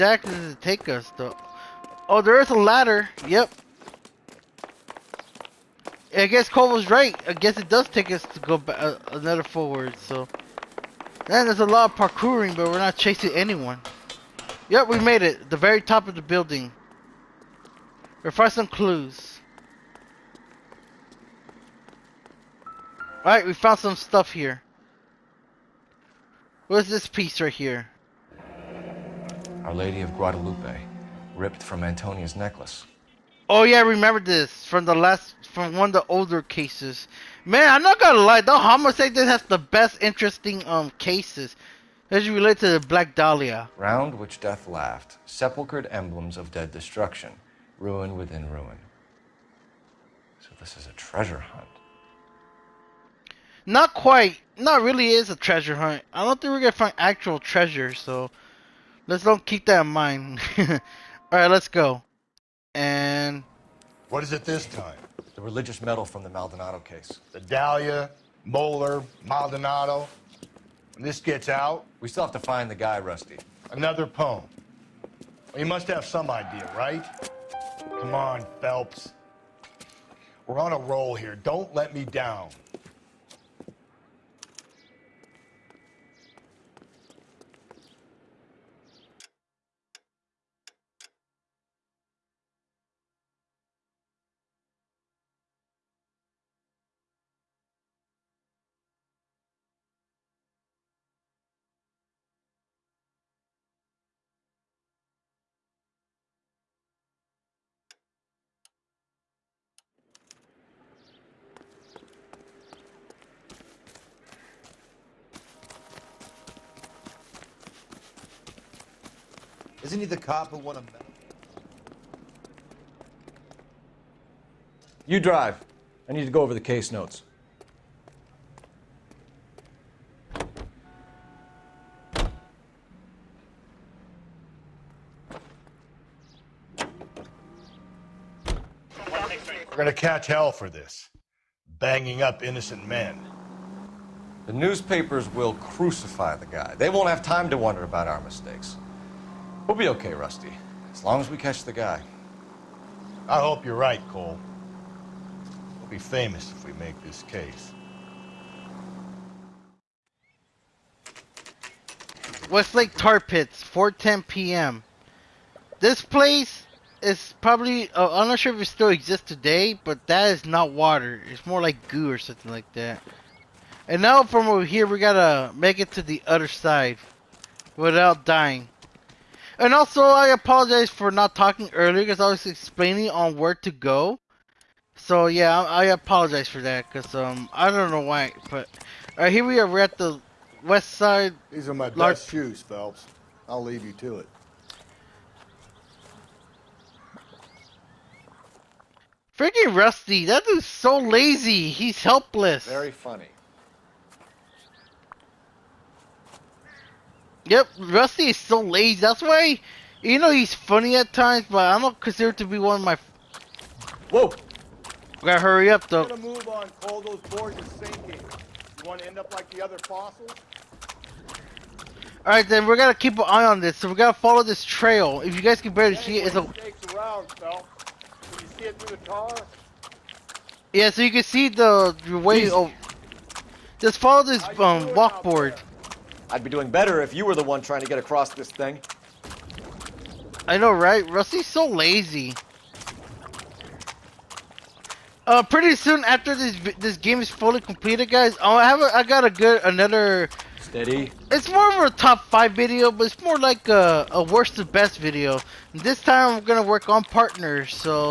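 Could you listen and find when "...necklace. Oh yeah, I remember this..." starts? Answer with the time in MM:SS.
00:32.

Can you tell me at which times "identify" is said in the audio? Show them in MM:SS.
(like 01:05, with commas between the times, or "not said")
not said.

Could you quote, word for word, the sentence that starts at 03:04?
So yeah, I, apologize for that because um I don't know why, but all right, here we are.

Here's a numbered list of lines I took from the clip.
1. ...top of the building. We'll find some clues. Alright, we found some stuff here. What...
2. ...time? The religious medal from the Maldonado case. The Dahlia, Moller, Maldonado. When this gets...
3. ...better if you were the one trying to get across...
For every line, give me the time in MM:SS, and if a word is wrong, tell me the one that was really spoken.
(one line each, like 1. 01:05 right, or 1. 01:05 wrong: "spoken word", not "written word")
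1. 00:15 right
2. 01:04 right
3. 03:56 right.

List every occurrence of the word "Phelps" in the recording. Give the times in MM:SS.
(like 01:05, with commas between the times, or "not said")
01:18, 03:12.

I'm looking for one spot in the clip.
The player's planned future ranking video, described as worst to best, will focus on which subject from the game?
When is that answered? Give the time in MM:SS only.
04:17.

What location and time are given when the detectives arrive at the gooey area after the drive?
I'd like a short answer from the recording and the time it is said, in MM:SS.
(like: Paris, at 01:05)
Westlake Tar Pits, 4:10 p.m., at 02:42.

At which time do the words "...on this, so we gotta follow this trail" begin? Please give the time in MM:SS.
03:43.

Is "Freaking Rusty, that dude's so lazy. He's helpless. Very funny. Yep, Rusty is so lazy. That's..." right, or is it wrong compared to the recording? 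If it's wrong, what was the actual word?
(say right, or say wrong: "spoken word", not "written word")
right.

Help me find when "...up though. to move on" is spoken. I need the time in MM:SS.
03:35.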